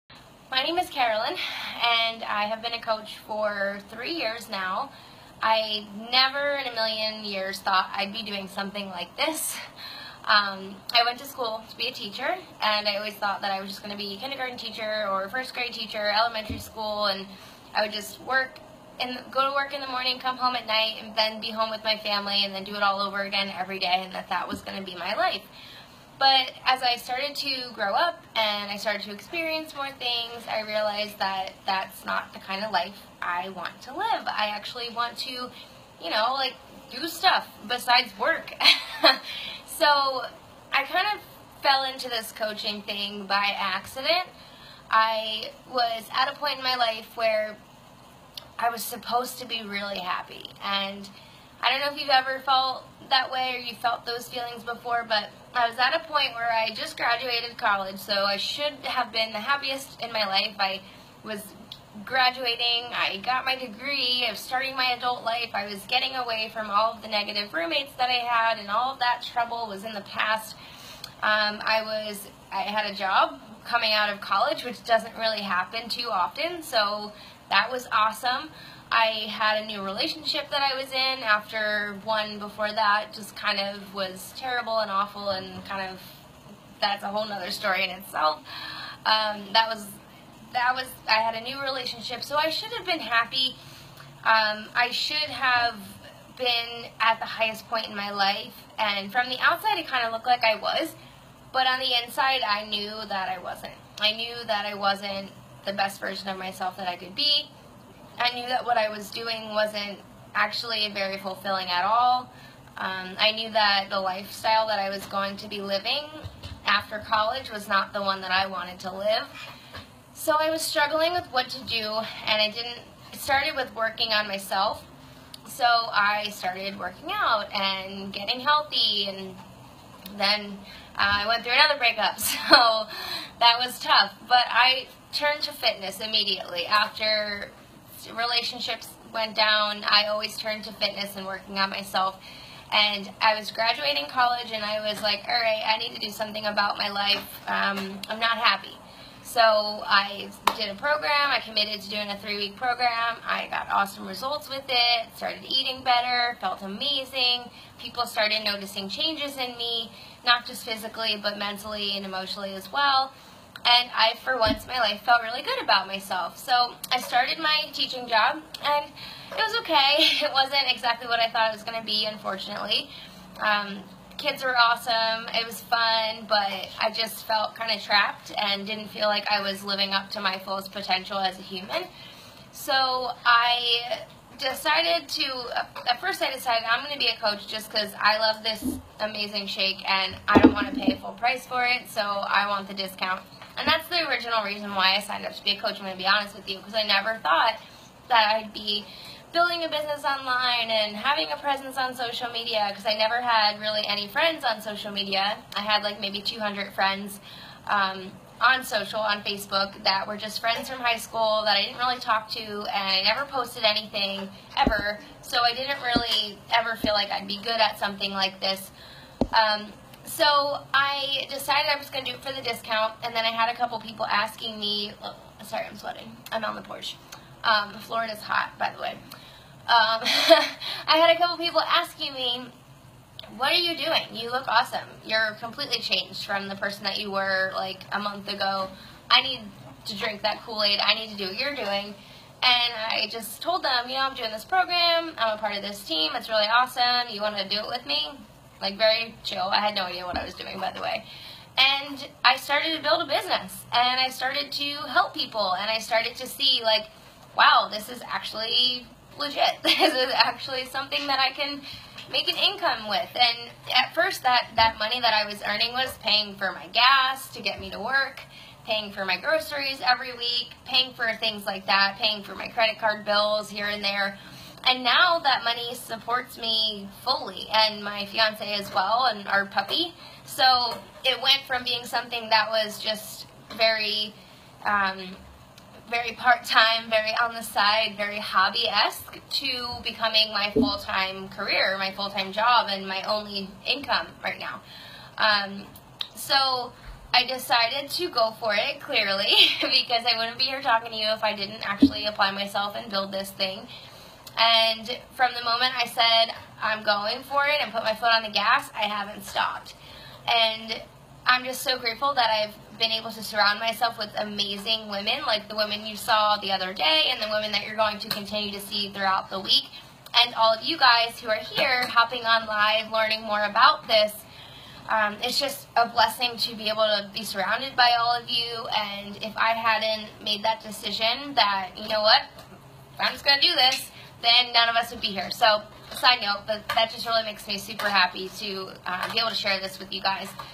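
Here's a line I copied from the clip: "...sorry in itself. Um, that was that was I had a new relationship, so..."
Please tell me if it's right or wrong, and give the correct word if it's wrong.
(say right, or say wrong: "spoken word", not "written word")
wrong: "story", not "sorry".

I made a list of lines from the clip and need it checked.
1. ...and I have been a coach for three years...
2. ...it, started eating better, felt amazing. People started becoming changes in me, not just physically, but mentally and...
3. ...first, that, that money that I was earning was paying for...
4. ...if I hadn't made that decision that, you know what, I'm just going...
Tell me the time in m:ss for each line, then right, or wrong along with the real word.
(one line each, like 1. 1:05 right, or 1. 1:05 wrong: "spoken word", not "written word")
1. 0:01 right
2. 2:34 wrong: "noticing", not "becoming"
3. 4:23 right
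4. 5:29 right.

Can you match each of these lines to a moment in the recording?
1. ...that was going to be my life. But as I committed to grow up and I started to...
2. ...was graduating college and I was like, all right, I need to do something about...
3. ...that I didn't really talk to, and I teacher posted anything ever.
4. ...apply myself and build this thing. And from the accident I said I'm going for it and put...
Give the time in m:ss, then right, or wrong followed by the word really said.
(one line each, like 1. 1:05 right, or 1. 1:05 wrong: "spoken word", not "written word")
1. 0:24 wrong: "started", not "committed"
2. 2:23 right
3. 3:31 wrong: "never", not "teacher"
4. 5:02 wrong: "moment", not "accident".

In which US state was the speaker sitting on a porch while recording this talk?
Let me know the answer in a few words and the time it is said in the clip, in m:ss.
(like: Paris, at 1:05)
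Florida, at 3:47.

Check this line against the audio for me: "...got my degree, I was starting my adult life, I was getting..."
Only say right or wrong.
right.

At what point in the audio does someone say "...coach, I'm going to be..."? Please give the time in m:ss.
3:15.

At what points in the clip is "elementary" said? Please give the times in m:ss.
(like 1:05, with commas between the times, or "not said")
0:16.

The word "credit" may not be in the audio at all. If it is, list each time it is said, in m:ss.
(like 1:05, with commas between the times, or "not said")
4:32.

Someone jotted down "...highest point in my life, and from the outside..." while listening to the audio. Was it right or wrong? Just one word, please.
right.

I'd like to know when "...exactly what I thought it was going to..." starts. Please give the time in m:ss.
2:50.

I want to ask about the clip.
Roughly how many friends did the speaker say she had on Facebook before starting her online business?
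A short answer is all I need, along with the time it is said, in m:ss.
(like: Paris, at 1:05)
200, at 3:26.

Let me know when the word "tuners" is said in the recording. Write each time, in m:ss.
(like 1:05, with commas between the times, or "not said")
not said.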